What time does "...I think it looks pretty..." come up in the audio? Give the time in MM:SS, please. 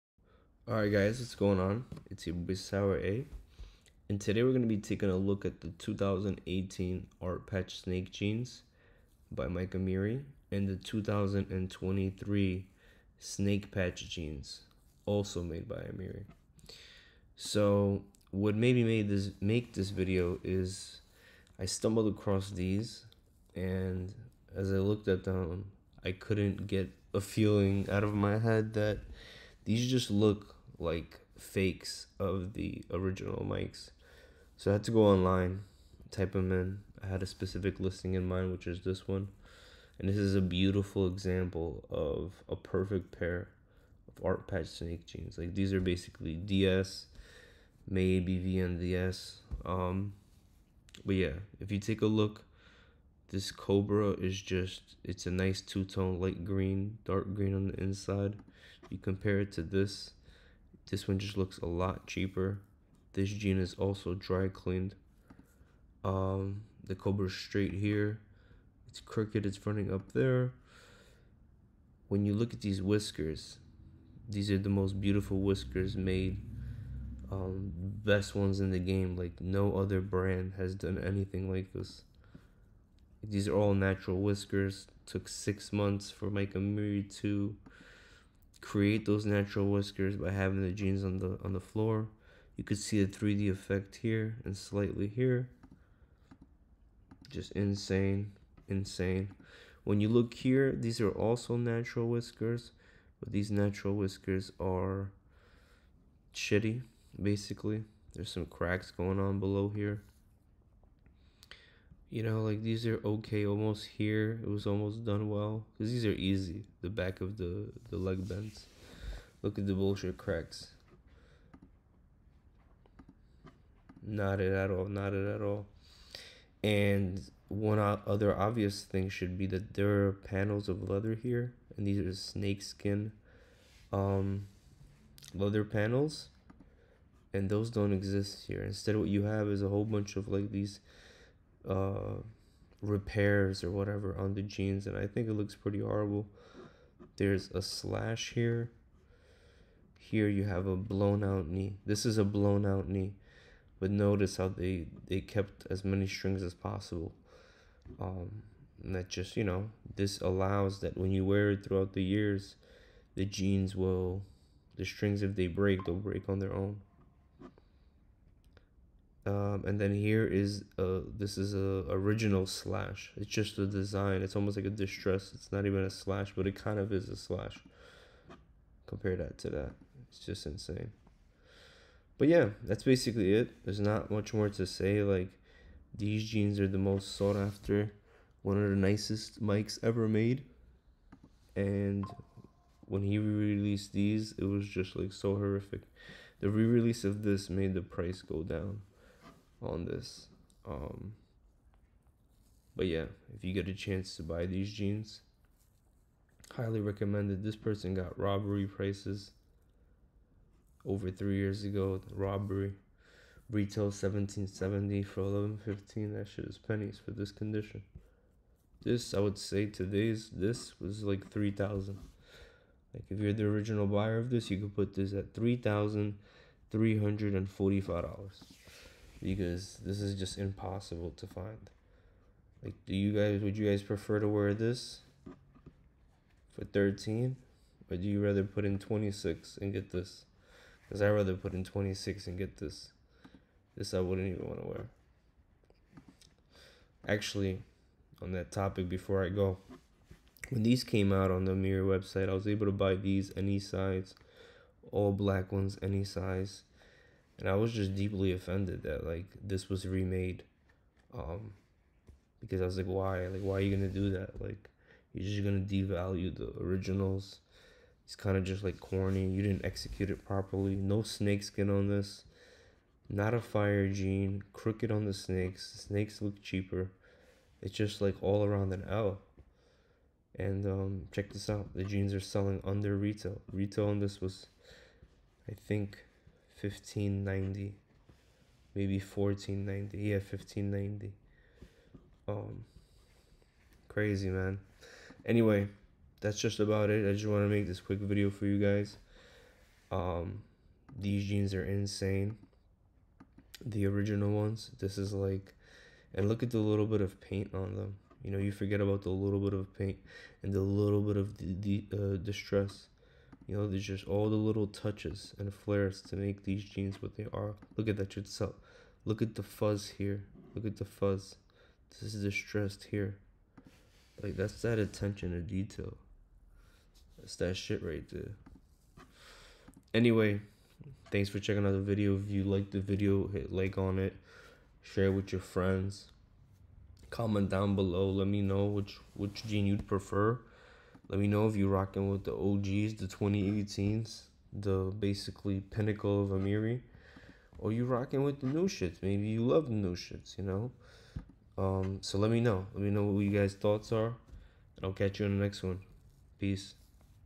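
02:24.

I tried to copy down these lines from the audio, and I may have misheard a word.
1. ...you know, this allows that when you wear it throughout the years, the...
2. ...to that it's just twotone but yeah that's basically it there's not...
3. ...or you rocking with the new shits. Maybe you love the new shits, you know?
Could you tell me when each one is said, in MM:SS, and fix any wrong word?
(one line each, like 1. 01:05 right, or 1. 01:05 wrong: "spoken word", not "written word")
1. 02:39 right
2. 02:59 wrong: "insane", not "twotone"
3. 05:47 right.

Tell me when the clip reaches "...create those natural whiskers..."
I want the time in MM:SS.
01:28.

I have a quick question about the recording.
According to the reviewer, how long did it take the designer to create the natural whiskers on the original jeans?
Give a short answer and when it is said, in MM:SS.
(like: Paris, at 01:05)
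6 months, at 01:25.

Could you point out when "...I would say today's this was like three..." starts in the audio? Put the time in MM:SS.
03:39.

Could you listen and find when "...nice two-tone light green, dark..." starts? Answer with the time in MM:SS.
00:55.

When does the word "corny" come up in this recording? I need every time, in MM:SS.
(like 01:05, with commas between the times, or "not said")
04:28.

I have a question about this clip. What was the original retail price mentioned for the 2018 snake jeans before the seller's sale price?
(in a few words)
1770.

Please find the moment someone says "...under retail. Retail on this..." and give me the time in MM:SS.
04:42.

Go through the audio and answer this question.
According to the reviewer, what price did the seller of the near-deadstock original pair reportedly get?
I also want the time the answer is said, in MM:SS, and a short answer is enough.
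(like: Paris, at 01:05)
1115, at 03:35.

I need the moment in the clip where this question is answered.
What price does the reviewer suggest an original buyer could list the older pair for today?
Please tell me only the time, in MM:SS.
03:45.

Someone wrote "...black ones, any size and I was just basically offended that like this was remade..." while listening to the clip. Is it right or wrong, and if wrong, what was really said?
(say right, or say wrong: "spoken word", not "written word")
wrong: "deeply", not "basically".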